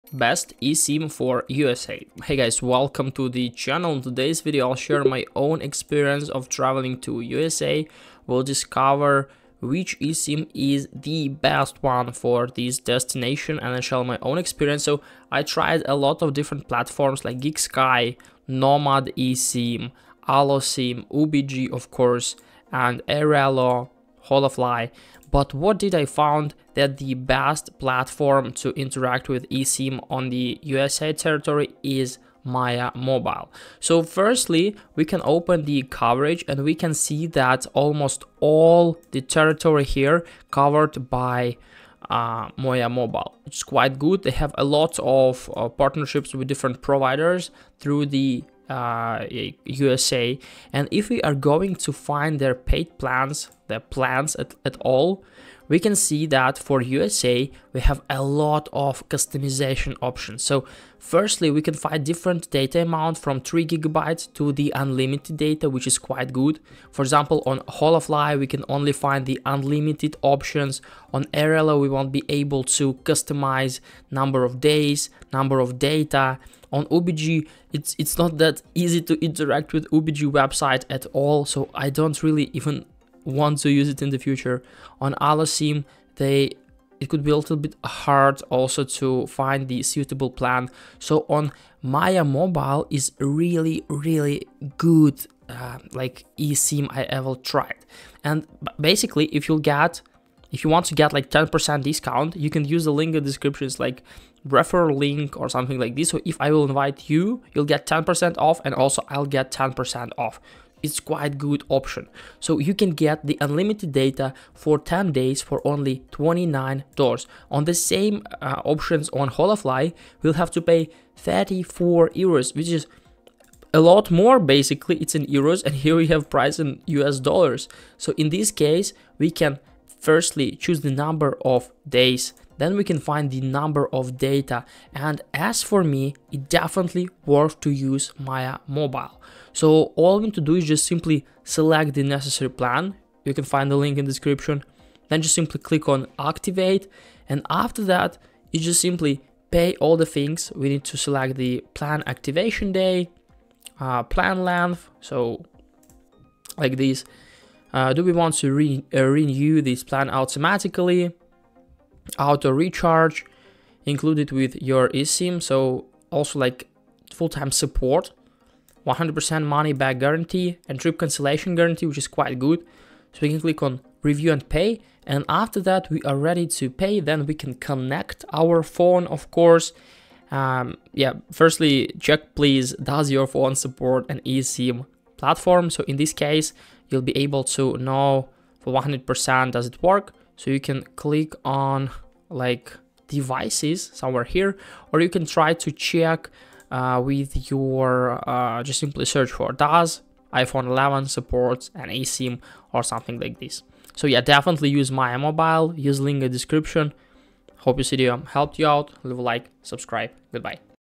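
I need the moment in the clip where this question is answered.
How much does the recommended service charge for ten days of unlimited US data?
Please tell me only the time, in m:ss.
1:56.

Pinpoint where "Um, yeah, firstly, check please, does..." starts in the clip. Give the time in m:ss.
3:00.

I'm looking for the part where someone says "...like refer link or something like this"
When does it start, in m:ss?
1:43.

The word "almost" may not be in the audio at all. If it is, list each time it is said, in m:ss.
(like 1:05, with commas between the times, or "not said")
0:37.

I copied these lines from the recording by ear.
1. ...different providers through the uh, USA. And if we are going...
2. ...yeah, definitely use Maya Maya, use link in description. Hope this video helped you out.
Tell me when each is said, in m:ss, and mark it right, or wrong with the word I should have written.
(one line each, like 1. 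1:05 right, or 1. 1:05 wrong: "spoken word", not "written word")
1. 0:46 right
2. 3:24 wrong: "Mobile", not "Maya".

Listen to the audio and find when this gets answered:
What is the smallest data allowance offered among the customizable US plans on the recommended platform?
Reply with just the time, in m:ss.
1:03.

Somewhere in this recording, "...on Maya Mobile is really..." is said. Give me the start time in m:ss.
1:31.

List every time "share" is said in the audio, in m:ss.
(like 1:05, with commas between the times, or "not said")
0:04, 0:13.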